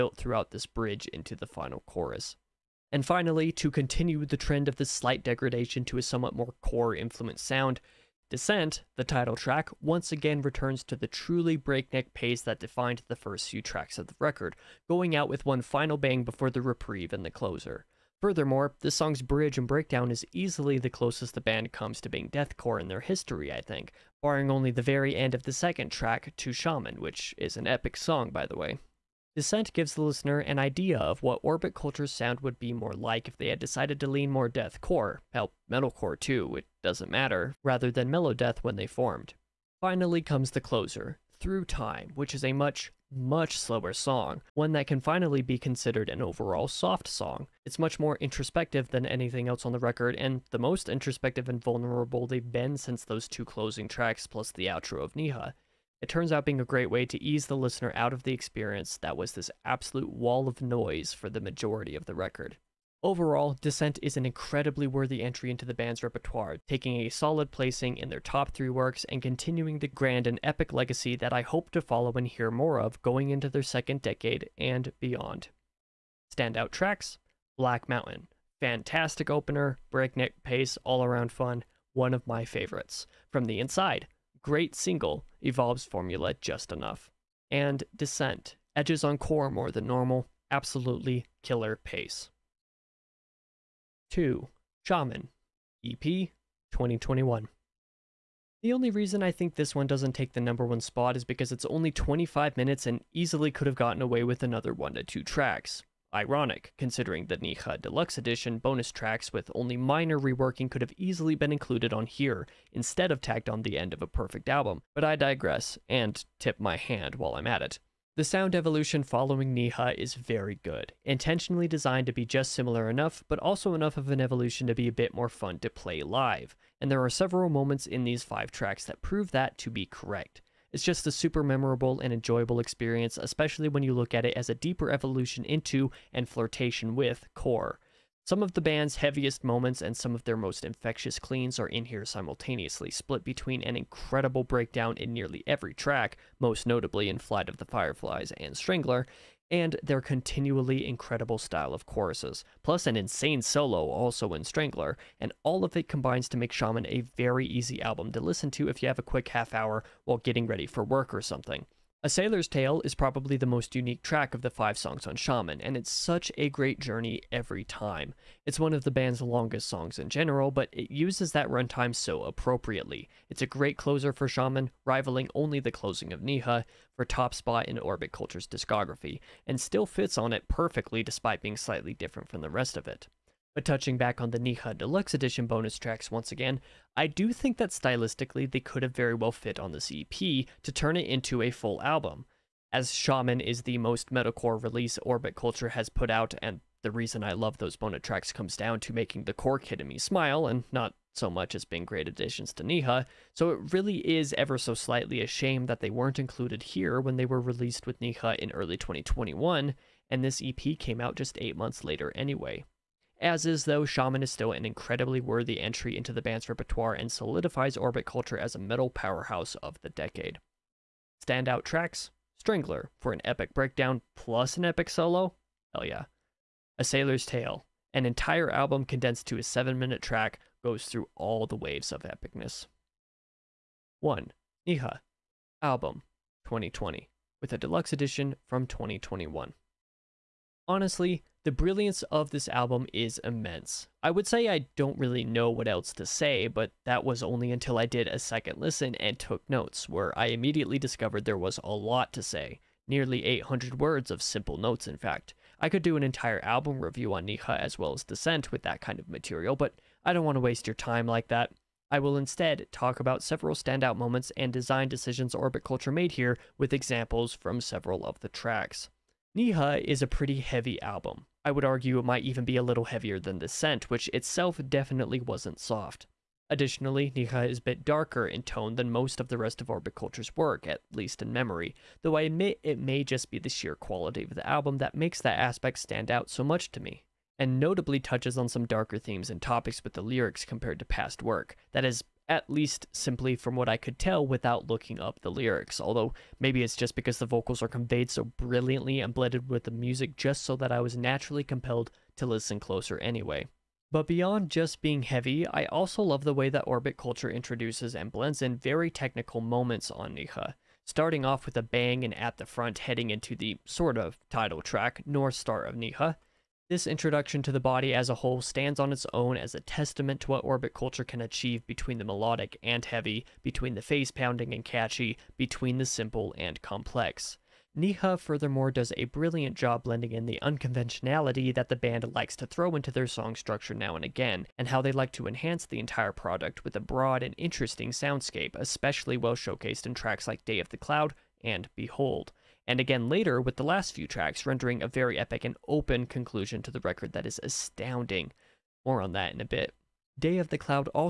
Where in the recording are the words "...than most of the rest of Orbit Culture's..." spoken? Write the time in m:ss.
4:38.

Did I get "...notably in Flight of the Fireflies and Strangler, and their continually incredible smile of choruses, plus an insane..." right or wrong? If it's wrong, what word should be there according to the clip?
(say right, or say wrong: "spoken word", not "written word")
wrong: "style", not "smile".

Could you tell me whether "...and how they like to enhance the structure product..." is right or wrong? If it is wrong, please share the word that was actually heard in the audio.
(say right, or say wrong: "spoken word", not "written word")
wrong: "entire", not "structure".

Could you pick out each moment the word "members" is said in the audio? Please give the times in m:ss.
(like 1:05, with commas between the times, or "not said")
not said.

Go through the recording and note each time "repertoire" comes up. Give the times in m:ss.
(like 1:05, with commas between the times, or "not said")
1:06, 3:36.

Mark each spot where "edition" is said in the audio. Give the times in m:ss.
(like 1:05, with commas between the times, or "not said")
1:48, 3:05, 3:57.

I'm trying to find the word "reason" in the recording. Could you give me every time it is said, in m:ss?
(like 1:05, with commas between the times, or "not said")
1:38, 3:16.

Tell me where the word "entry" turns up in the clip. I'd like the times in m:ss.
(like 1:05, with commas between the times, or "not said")
1:05, 3:35.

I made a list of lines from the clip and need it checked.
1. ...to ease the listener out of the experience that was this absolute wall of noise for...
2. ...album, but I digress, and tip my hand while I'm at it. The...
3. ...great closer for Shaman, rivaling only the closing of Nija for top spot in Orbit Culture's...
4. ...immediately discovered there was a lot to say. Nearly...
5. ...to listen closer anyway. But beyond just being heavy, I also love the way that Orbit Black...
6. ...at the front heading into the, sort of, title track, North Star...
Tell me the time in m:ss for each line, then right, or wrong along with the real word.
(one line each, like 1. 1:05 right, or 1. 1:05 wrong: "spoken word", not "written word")
1. 0:57 right
2. 1:54 right
3. 2:53 right
4. 4:10 right
5. 5:02 wrong: "Culture", not "Black"
6. 5:12 right.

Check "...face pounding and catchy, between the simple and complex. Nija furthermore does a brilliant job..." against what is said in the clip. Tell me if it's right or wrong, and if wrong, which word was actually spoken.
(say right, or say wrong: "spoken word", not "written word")
right.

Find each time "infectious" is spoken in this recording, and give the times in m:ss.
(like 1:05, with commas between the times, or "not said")
2:20.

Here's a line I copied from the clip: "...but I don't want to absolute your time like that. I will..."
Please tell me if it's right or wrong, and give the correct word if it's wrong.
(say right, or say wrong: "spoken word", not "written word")
wrong: "waste", not "absolute".